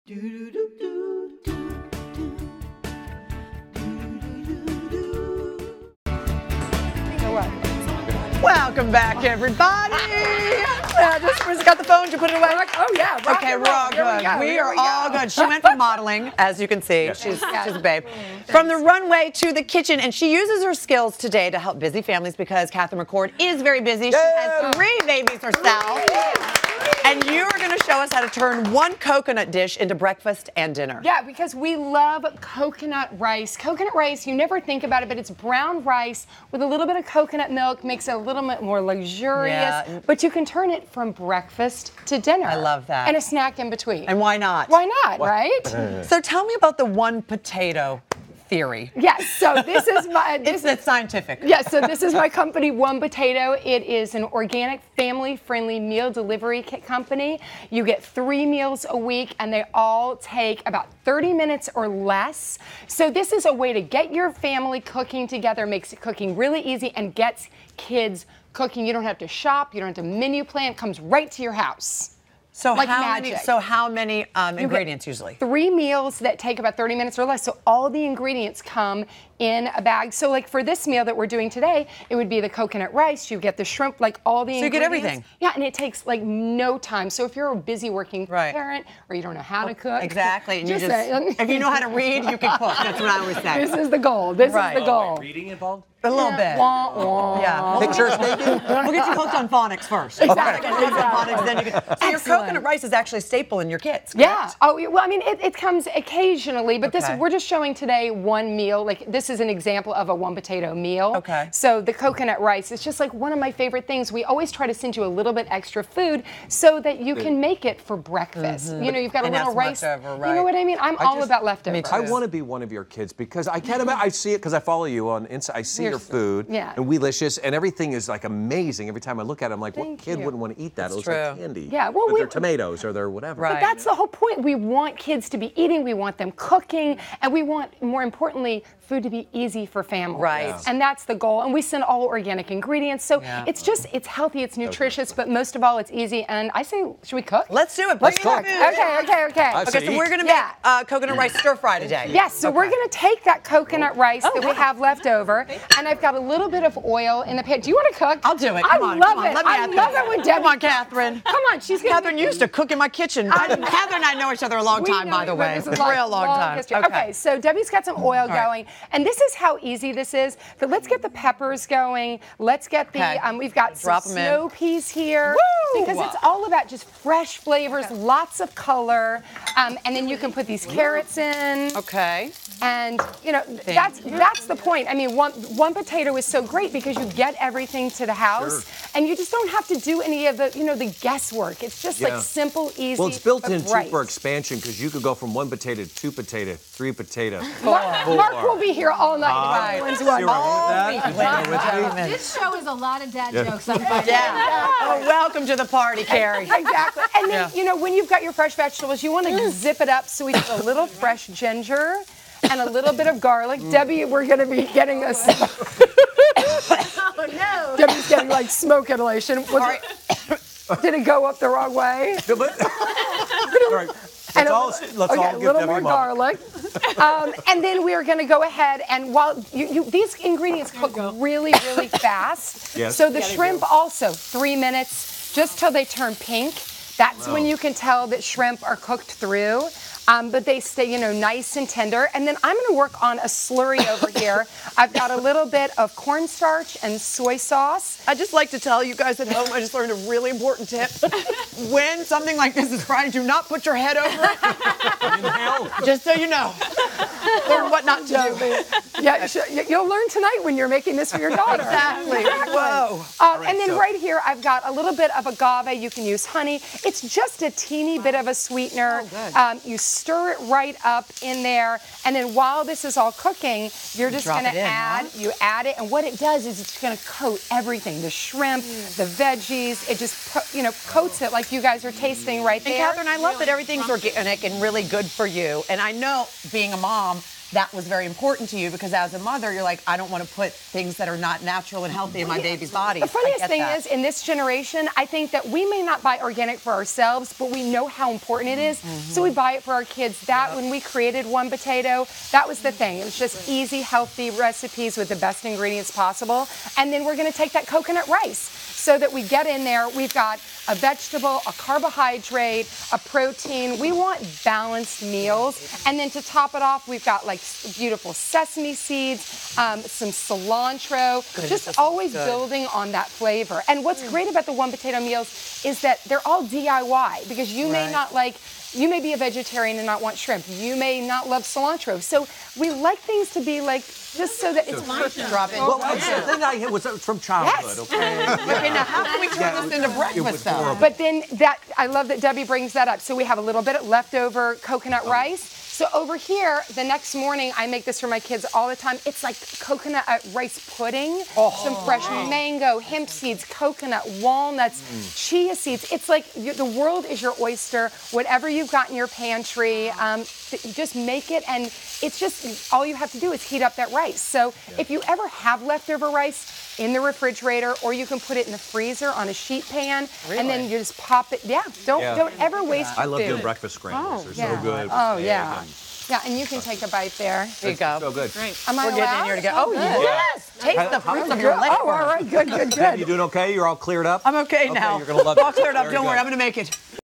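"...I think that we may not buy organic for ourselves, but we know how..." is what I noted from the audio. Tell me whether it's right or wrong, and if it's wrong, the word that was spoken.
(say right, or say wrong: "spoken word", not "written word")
right.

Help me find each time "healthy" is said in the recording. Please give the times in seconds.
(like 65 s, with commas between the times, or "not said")
144 s, 291 s, 303 s.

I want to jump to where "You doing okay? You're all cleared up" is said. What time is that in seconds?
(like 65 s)
382 s.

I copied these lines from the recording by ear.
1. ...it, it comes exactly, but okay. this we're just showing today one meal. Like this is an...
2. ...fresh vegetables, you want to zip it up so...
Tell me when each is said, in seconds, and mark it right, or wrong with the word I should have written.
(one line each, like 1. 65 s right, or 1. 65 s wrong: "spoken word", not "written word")
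1. 105 s wrong: "occasionally", not "exactly"
2. 208 s right.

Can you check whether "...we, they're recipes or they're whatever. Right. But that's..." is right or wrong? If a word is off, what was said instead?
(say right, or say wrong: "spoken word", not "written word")
wrong: "tomatoes", not "recipes".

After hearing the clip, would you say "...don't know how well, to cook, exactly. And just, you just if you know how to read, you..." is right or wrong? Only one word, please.
right.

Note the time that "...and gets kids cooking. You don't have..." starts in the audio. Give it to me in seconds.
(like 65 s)
66 s.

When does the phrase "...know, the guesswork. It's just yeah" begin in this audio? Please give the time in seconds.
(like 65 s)
190 s.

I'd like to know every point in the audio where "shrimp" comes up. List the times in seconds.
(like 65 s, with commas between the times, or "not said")
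83 s, 233 s, 238 s, 278 s, 330 s.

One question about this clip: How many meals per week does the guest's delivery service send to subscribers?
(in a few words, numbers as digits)
3.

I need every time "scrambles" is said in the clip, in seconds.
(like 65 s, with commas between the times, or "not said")
373 s.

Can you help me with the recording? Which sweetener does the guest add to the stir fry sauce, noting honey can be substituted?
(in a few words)
agave.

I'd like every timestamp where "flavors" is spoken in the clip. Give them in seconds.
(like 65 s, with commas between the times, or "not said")
177 s, 323 s.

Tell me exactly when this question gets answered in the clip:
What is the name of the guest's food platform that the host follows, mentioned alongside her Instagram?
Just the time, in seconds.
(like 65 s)
126 s.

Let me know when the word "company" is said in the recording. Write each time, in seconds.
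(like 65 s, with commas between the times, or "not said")
52 s, 56 s.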